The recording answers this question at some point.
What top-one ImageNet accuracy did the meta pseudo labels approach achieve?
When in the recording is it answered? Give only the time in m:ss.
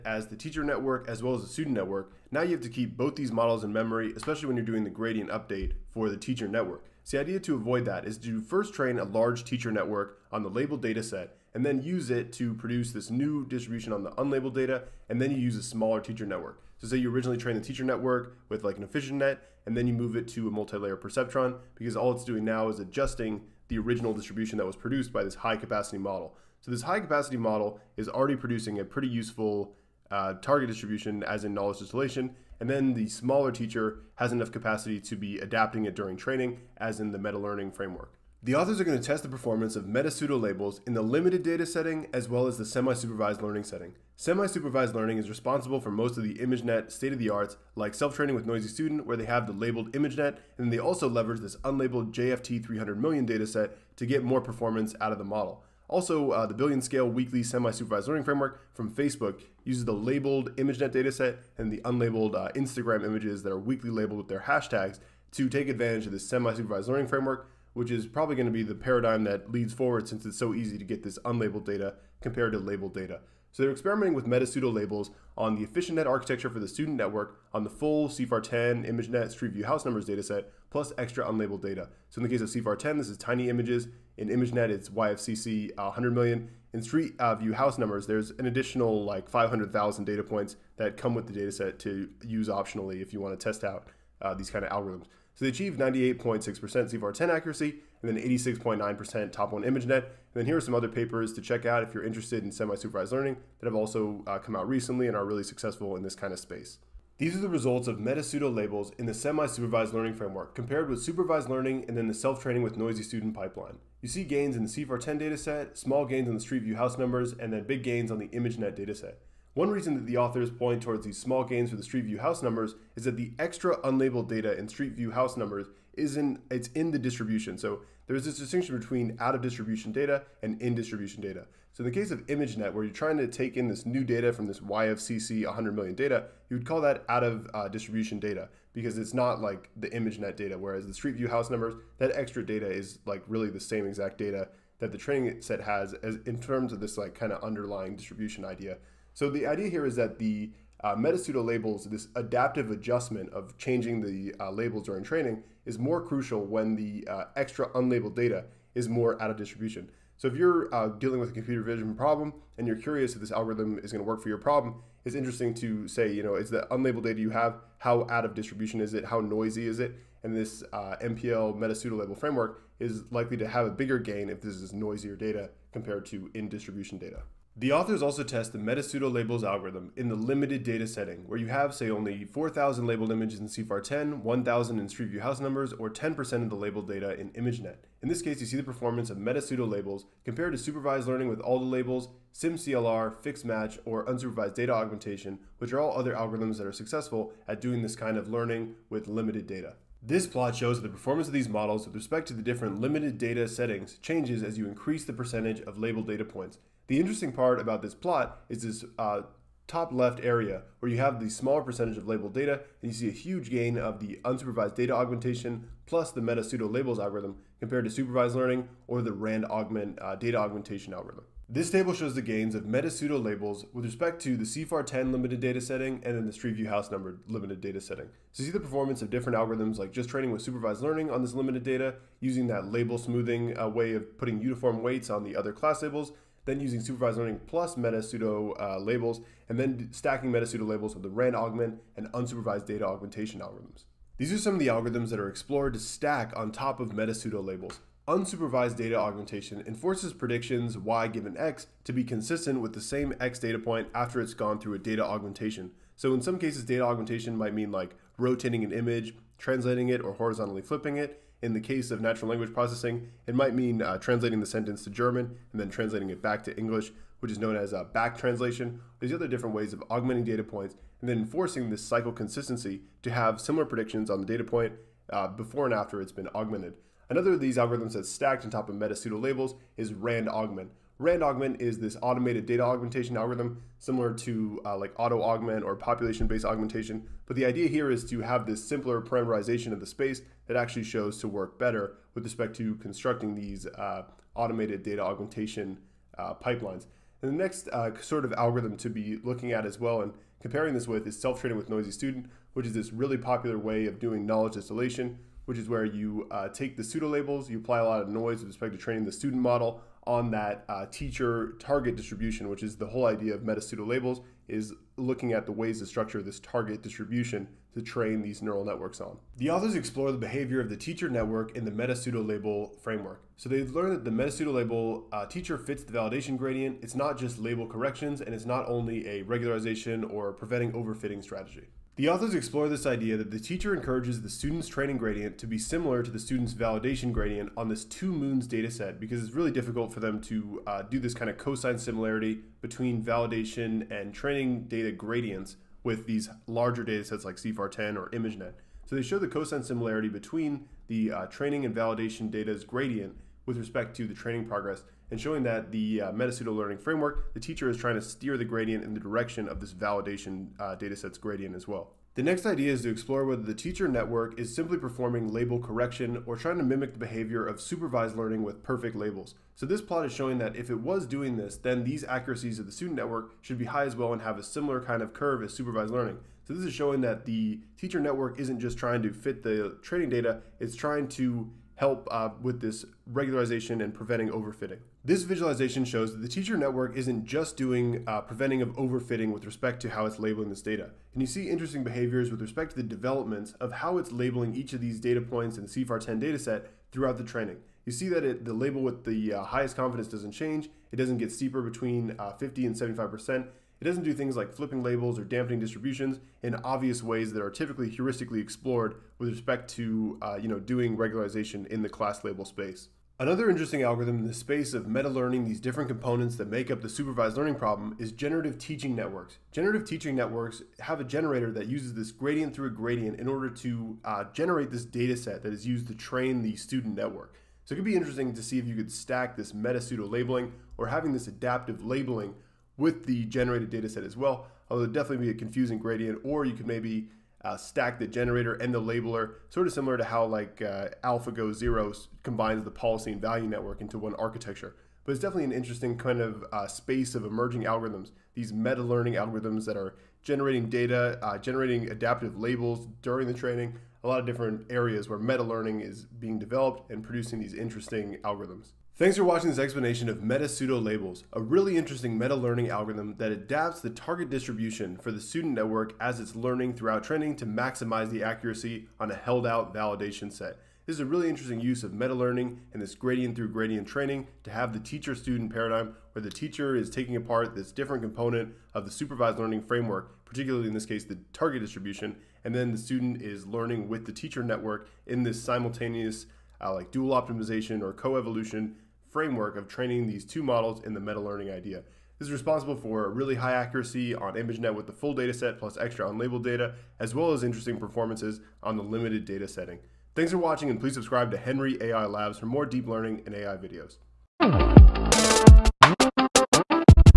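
1:38.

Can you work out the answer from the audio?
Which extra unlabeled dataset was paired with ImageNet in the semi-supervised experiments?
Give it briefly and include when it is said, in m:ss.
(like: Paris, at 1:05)
YFCC 100 million, at 1:24.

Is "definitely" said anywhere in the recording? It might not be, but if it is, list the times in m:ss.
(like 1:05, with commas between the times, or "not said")
7:14, 7:25.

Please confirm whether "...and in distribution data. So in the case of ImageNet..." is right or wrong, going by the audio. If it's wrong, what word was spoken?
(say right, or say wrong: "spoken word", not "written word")
right.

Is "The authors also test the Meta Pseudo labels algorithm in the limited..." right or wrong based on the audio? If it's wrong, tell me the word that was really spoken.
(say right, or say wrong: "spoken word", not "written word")
right.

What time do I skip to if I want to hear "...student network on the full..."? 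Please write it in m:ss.
1:16.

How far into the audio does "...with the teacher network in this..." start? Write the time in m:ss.
8:03.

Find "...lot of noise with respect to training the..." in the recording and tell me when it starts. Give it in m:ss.
5:07.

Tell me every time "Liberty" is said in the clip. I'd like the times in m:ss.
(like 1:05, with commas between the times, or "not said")
not said.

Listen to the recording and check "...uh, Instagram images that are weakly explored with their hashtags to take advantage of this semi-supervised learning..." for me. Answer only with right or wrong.
wrong.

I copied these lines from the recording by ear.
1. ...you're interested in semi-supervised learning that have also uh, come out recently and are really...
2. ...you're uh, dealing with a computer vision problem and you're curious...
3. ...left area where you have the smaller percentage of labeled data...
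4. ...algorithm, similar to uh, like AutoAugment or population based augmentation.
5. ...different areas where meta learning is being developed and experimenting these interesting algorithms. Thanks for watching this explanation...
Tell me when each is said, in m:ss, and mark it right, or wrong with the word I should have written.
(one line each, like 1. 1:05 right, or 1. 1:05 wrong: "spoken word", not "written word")
1. 1:41 right
2. 2:40 right
3. 3:29 right
4. 4:43 right
5. 7:34 wrong: "producing", not "experimenting".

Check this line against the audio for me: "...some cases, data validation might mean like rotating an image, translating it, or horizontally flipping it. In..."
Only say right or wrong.
wrong.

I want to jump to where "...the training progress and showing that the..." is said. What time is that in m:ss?
5:54.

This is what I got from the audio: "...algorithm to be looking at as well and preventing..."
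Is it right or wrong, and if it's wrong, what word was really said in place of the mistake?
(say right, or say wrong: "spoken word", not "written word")
wrong: "comparing", not "preventing".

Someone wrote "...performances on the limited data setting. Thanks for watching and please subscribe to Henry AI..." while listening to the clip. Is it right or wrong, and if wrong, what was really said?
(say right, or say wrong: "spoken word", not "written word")
right.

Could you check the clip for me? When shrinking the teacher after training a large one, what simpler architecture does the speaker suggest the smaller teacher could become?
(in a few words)
multi-layer perceptron.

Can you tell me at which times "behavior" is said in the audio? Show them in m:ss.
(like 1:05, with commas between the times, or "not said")
5:20, 6:06, 6:31.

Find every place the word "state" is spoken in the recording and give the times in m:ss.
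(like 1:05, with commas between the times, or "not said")
0:46.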